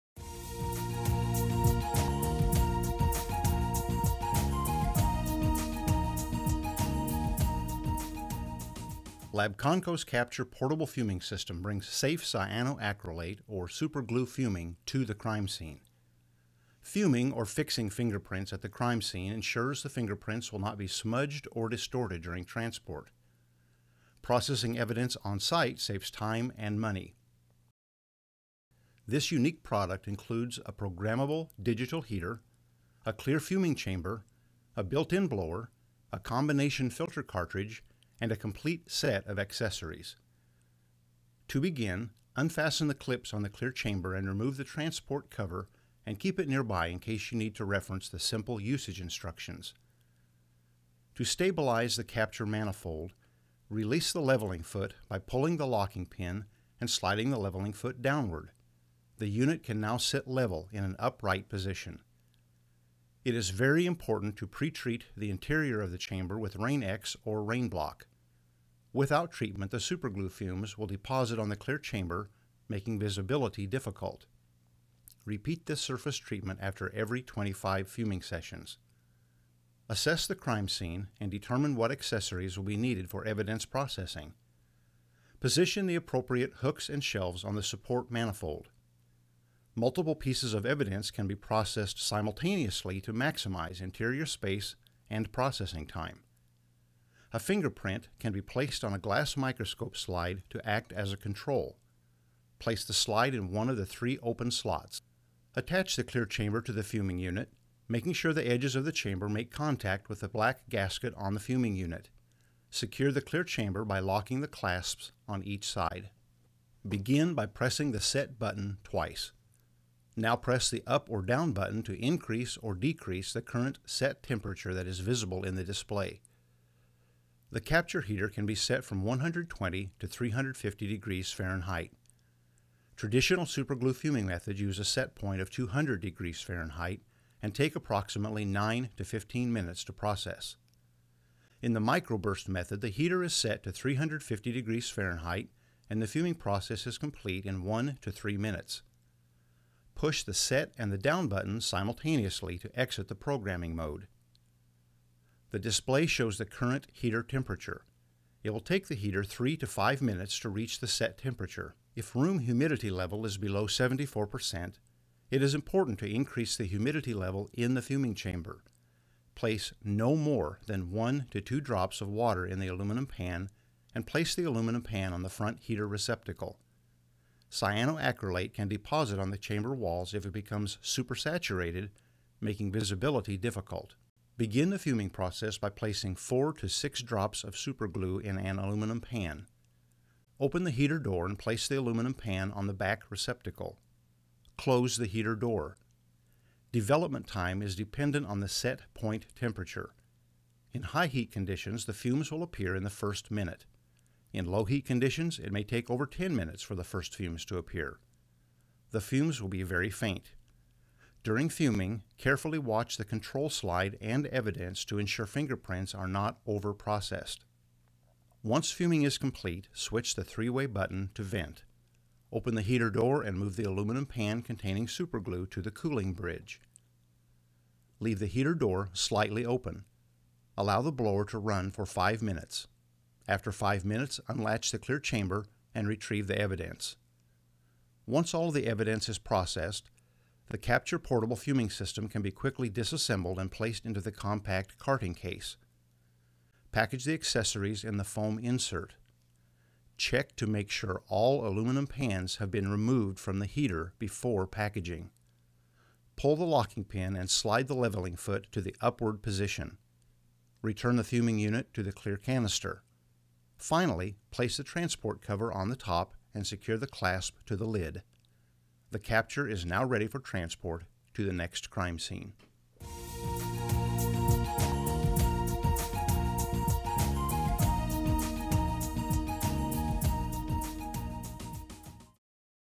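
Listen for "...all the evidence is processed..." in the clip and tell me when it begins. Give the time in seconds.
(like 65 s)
238 s.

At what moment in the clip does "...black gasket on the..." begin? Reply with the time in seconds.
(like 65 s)
110 s.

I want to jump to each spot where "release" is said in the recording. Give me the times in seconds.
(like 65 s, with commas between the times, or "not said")
53 s.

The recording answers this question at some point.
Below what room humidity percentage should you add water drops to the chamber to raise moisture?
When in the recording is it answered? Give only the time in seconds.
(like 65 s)
163 s.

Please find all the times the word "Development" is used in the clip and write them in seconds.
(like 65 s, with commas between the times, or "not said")
196 s.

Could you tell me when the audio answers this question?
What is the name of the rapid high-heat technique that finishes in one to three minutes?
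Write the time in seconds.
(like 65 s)
141 s.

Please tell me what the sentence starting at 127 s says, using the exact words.
The capture heater can be set from 120 to 350 degrees Fahrenheit.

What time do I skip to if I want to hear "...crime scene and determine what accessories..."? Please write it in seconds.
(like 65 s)
80 s.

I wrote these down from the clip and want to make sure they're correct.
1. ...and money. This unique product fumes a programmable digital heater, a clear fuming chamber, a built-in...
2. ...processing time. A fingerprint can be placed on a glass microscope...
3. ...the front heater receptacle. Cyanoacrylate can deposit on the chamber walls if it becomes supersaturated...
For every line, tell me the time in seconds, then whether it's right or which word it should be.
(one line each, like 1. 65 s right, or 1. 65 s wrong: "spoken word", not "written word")
1. 26 s wrong: "includes", not "fumes"
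2. 95 s right
3. 175 s right.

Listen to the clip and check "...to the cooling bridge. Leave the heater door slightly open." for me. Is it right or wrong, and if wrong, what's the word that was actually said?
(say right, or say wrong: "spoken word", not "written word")
right.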